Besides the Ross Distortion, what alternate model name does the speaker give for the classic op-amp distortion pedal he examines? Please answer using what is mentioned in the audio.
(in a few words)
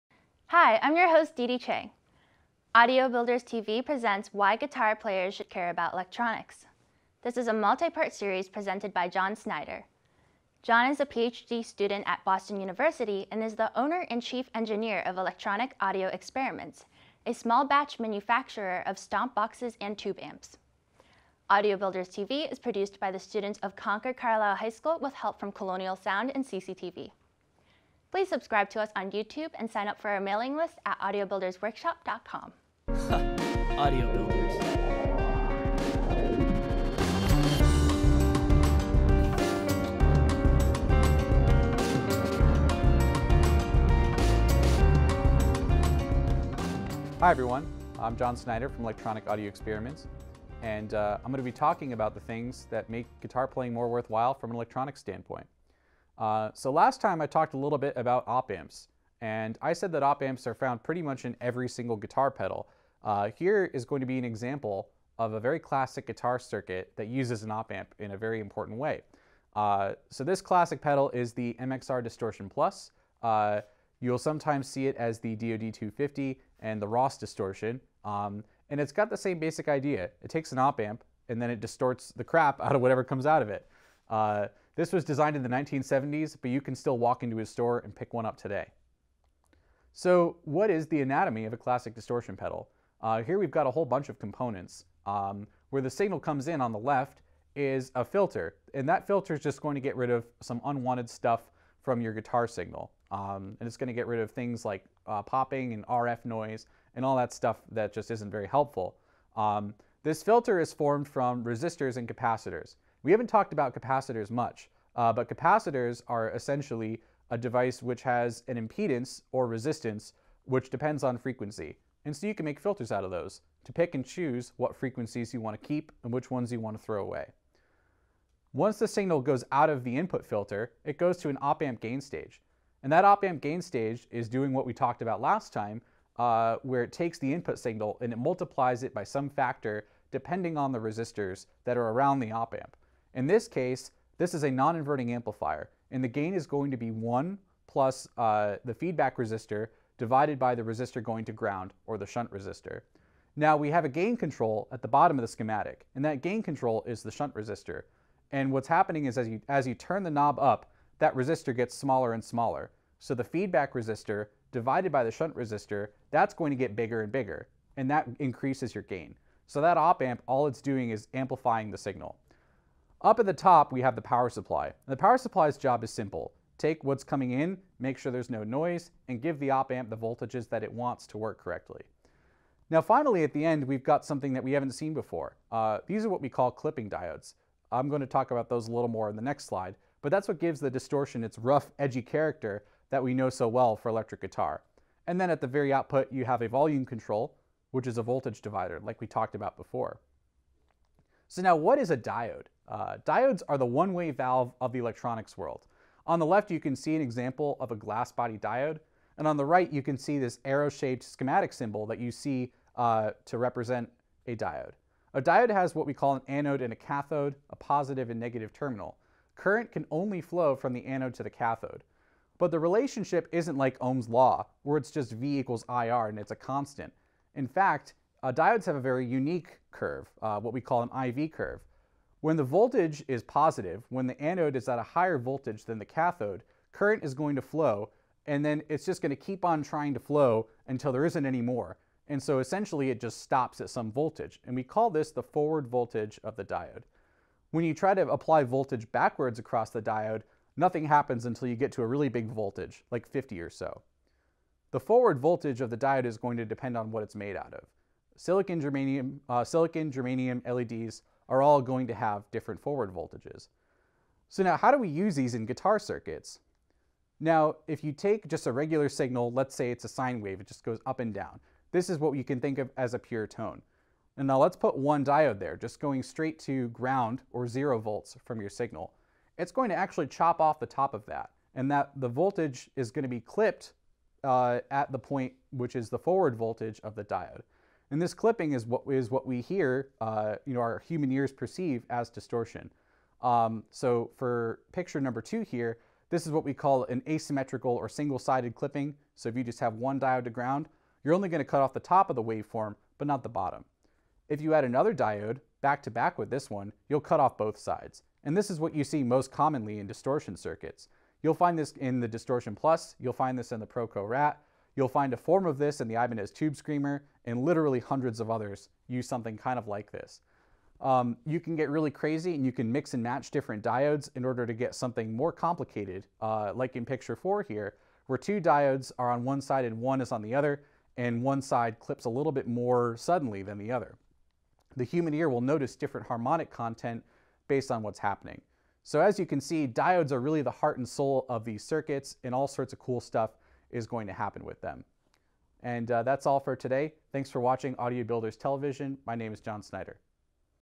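DoD250.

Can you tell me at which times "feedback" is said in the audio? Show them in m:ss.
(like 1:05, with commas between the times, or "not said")
2:28, 2:43.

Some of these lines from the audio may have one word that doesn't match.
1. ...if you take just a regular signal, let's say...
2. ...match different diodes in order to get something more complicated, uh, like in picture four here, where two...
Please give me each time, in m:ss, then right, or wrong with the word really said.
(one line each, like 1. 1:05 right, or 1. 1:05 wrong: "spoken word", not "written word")
1. 4:27 right
2. 5:23 right.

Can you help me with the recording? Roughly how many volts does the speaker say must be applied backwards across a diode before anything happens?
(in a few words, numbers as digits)
50.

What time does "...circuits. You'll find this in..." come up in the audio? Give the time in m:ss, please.
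5:10.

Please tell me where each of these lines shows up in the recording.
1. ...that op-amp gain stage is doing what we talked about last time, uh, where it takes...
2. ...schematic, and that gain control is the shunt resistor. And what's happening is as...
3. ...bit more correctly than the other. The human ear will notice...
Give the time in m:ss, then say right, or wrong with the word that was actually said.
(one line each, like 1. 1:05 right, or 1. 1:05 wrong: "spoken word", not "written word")
1. 2:12 right
2. 2:35 right
3. 5:32 wrong: "suddenly", not "correctly".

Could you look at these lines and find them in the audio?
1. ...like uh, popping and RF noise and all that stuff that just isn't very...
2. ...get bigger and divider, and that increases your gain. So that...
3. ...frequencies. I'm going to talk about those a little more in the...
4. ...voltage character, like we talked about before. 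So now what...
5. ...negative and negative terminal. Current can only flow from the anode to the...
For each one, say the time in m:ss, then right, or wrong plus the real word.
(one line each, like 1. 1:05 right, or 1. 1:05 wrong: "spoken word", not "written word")
1. 1:44 right
2. 2:46 wrong: "bigger", not "divider"
3. 3:06 wrong: "diodes", not "frequencies"
4. 3:18 wrong: "divider", not "character"
5. 3:37 wrong: "positive", not "negative".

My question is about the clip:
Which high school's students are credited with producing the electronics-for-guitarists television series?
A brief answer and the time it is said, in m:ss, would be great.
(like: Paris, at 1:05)
Concord Carlisle High School, at 0:23.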